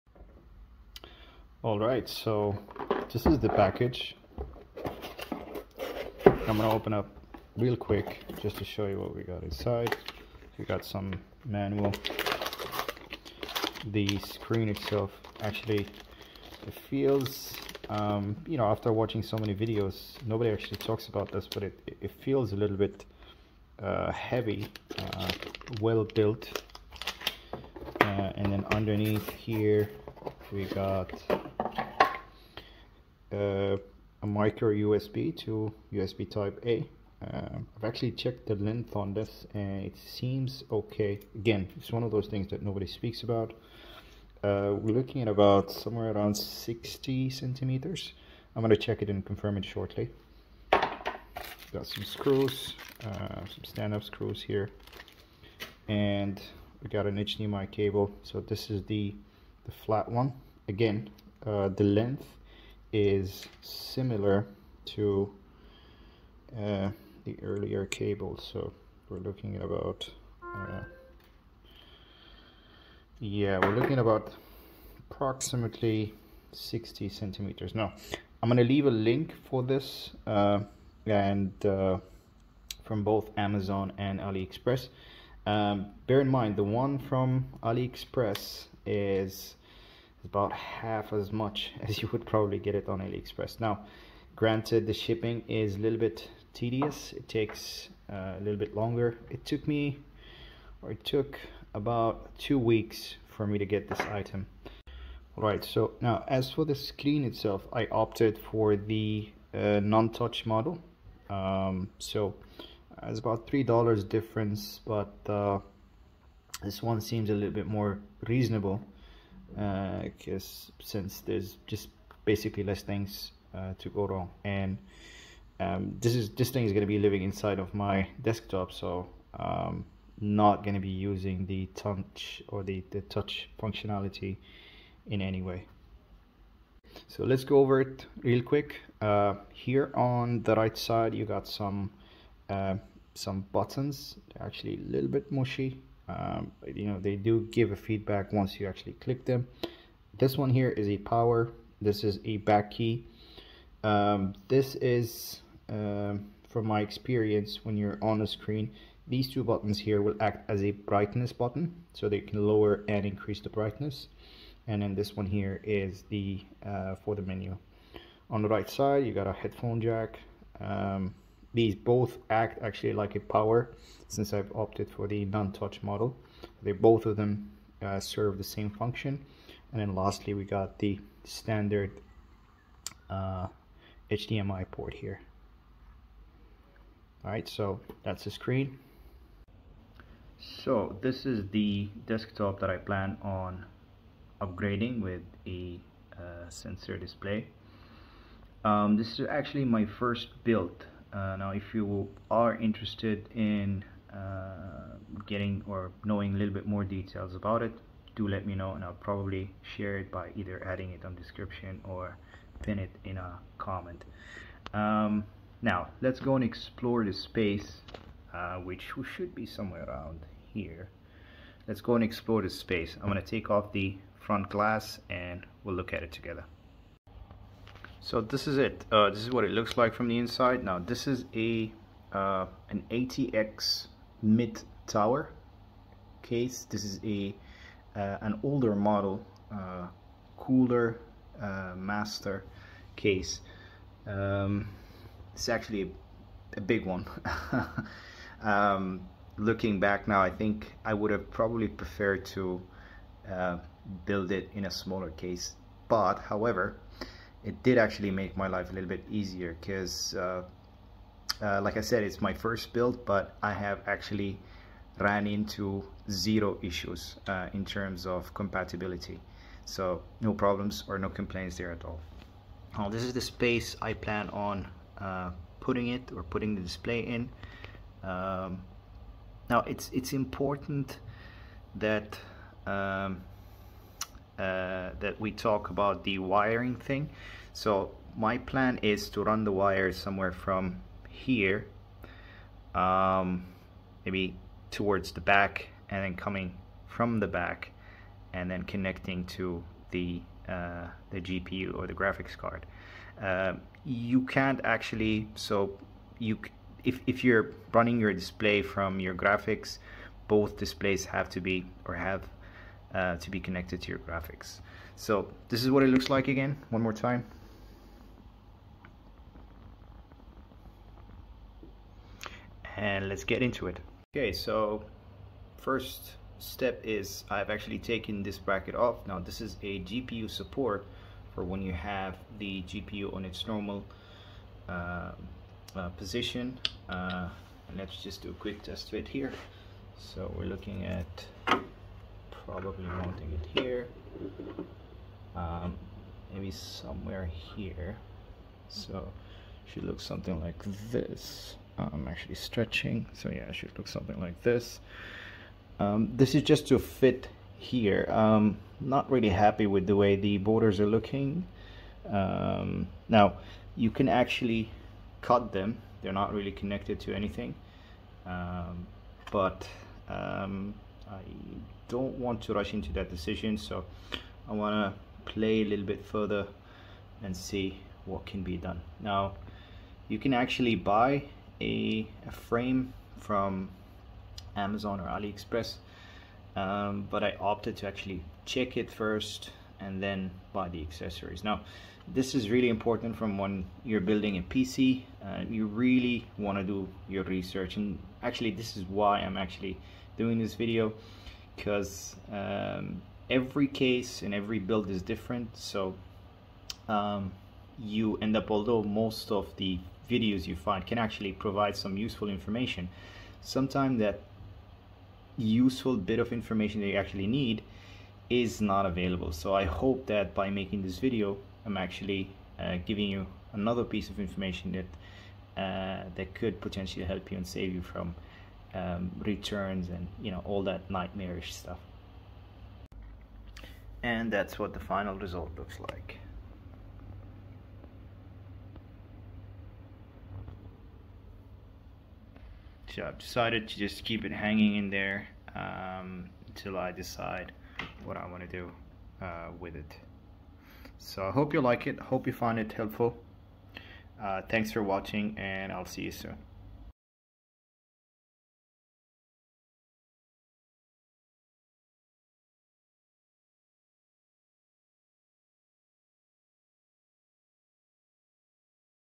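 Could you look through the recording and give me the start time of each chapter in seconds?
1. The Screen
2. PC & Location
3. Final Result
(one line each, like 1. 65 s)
1. 105 s
2. 190 s
3. 433 s.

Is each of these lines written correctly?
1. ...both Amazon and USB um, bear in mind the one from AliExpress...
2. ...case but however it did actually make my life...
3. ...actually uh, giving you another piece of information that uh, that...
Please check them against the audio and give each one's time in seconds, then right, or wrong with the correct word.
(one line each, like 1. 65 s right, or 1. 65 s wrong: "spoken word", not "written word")
1. 83 s wrong: "AliExpress", not "USB"
2. 255 s right
3. 421 s right.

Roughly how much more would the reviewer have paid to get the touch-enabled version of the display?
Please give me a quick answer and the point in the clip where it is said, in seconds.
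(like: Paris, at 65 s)
3 dollars, at 113 s.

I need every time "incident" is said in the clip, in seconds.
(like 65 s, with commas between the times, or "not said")
not said.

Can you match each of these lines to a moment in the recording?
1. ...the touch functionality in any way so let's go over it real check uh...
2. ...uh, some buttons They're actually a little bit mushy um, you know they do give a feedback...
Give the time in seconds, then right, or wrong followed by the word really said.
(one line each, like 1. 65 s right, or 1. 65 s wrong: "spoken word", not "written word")
1. 132 s wrong: "quick", not "check"
2. 142 s right.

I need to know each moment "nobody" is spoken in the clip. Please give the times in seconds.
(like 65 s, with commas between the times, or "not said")
20 s, 42 s.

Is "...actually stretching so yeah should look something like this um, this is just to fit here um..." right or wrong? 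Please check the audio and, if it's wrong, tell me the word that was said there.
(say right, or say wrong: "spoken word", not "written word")
right.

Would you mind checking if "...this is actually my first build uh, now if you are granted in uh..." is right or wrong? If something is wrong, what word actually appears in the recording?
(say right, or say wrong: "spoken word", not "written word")
wrong: "interested", not "granted".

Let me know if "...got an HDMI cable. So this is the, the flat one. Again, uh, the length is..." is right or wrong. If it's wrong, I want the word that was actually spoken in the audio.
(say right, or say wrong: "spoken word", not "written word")
right.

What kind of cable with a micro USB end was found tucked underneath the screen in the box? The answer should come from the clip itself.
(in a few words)
Micro USB to USB Type A.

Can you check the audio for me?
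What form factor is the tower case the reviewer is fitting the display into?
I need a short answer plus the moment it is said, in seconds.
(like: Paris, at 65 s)
ATX mid tower, at 232 s.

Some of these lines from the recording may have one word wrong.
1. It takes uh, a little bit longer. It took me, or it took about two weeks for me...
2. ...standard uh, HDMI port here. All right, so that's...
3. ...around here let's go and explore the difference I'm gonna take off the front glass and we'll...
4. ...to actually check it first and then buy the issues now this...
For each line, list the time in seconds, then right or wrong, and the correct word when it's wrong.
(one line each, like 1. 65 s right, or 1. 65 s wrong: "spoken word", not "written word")
1. 97 s right
2. 181 s right
3. 219 s wrong: "space", not "difference"
4. 387 s wrong: "accessories", not "issues".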